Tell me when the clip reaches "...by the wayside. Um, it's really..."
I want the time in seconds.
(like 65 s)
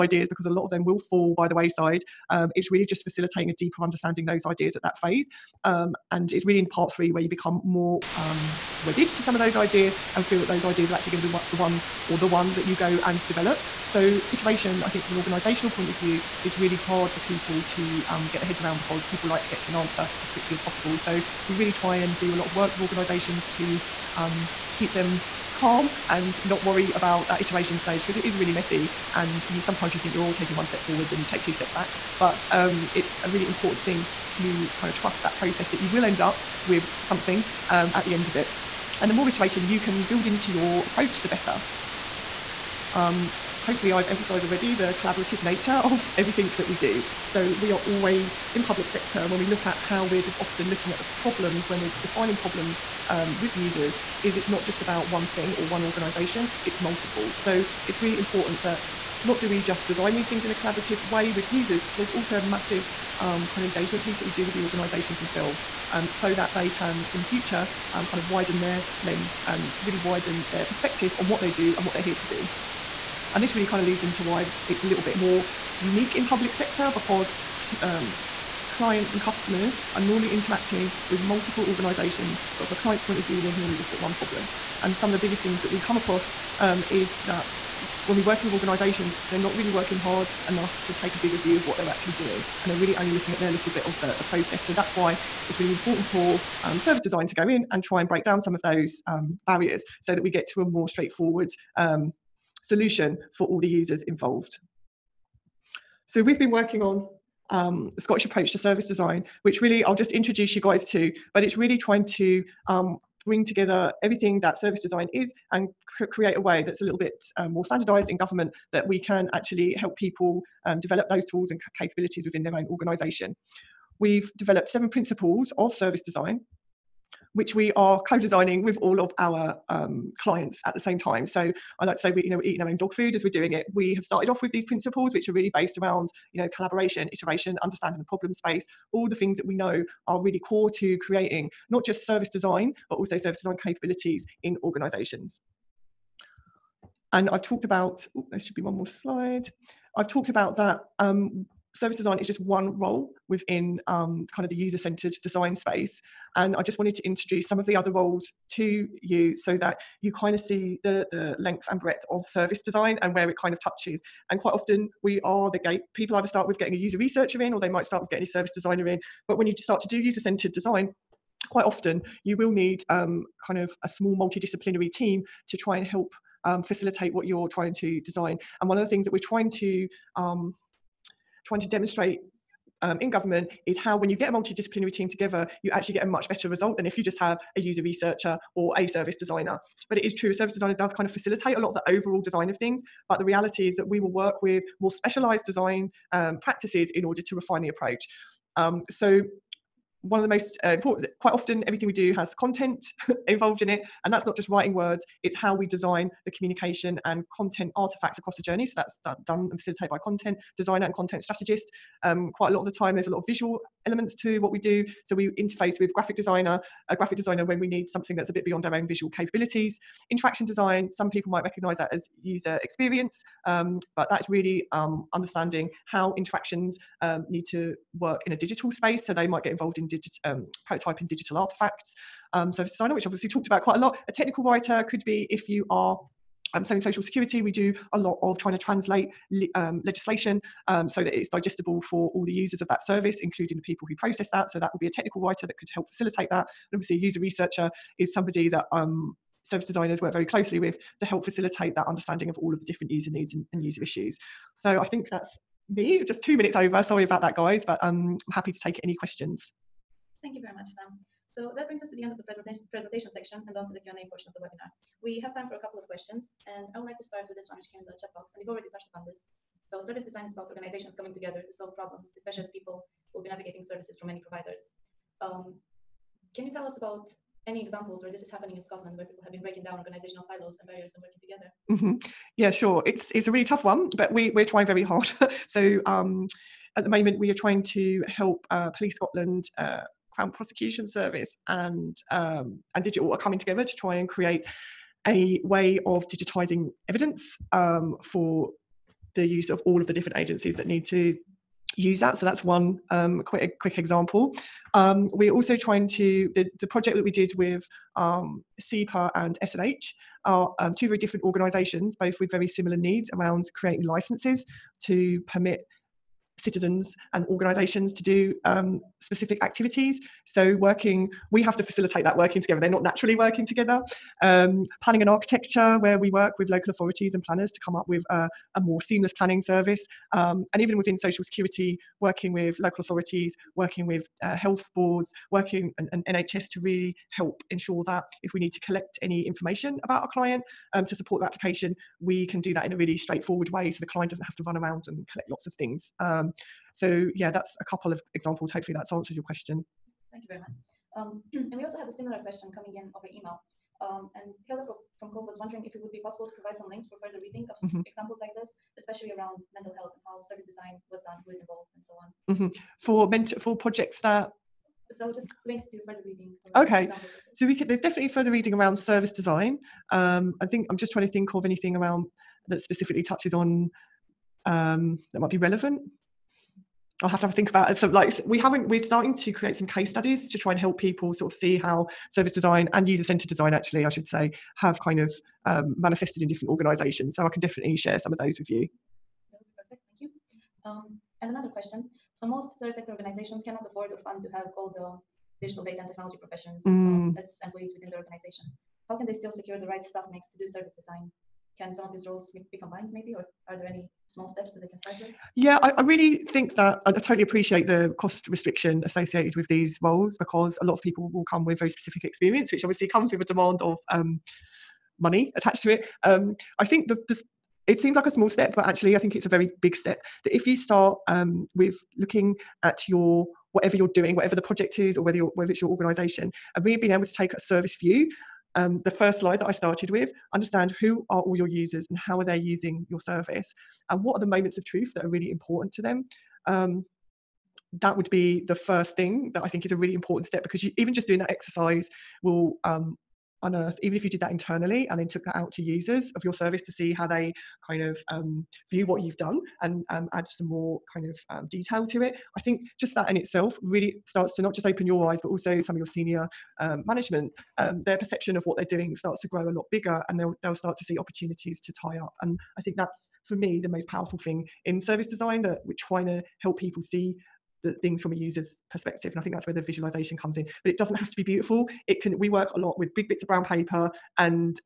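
1 s.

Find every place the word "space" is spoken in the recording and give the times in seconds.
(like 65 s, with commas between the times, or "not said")
138 s, 155 s, 228 s.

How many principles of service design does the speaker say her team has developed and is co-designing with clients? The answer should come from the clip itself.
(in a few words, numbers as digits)
7.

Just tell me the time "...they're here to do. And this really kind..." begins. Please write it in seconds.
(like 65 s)
71 s.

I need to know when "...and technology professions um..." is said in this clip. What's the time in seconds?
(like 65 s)
395 s.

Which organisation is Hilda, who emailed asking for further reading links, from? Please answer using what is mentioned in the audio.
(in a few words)
Cove.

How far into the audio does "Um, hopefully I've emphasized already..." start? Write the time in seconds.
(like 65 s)
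42 s.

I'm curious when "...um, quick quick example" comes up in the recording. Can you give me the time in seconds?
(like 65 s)
302 s.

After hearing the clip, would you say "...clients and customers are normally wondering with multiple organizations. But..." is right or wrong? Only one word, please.
wrong.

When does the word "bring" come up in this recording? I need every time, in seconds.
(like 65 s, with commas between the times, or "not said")
113 s, 261 s.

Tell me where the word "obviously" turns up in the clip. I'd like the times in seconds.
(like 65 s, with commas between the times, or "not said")
233 s, 246 s, 412 s.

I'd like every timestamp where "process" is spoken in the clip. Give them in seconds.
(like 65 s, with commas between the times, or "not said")
35 s, 94 s, 243 s.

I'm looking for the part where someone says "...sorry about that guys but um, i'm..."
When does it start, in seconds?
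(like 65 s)
256 s.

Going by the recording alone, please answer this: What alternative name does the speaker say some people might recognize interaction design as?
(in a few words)
User experience.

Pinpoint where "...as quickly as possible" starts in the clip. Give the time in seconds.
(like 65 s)
20 s.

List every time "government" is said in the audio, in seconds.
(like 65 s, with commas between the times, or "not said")
118 s, 183 s.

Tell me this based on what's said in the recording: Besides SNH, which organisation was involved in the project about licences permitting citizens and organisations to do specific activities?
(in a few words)
SEPA.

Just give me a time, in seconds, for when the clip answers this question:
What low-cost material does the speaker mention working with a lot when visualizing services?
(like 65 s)
472 s.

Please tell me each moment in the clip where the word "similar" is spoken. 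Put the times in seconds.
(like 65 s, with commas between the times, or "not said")
312 s, 351 s.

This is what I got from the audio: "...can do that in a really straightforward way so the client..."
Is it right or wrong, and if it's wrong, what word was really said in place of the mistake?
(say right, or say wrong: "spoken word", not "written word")
right.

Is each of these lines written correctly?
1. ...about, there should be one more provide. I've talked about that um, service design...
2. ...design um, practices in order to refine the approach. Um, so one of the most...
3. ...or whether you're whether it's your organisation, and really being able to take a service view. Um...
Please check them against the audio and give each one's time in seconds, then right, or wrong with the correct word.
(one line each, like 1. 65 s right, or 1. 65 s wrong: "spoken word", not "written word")
1. 147 s wrong: "slide", not "provide"
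2. 195 s right
3. 424 s right.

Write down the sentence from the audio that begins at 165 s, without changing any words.
People either start with getting a user researcher in, or they might start with getting a service designer in.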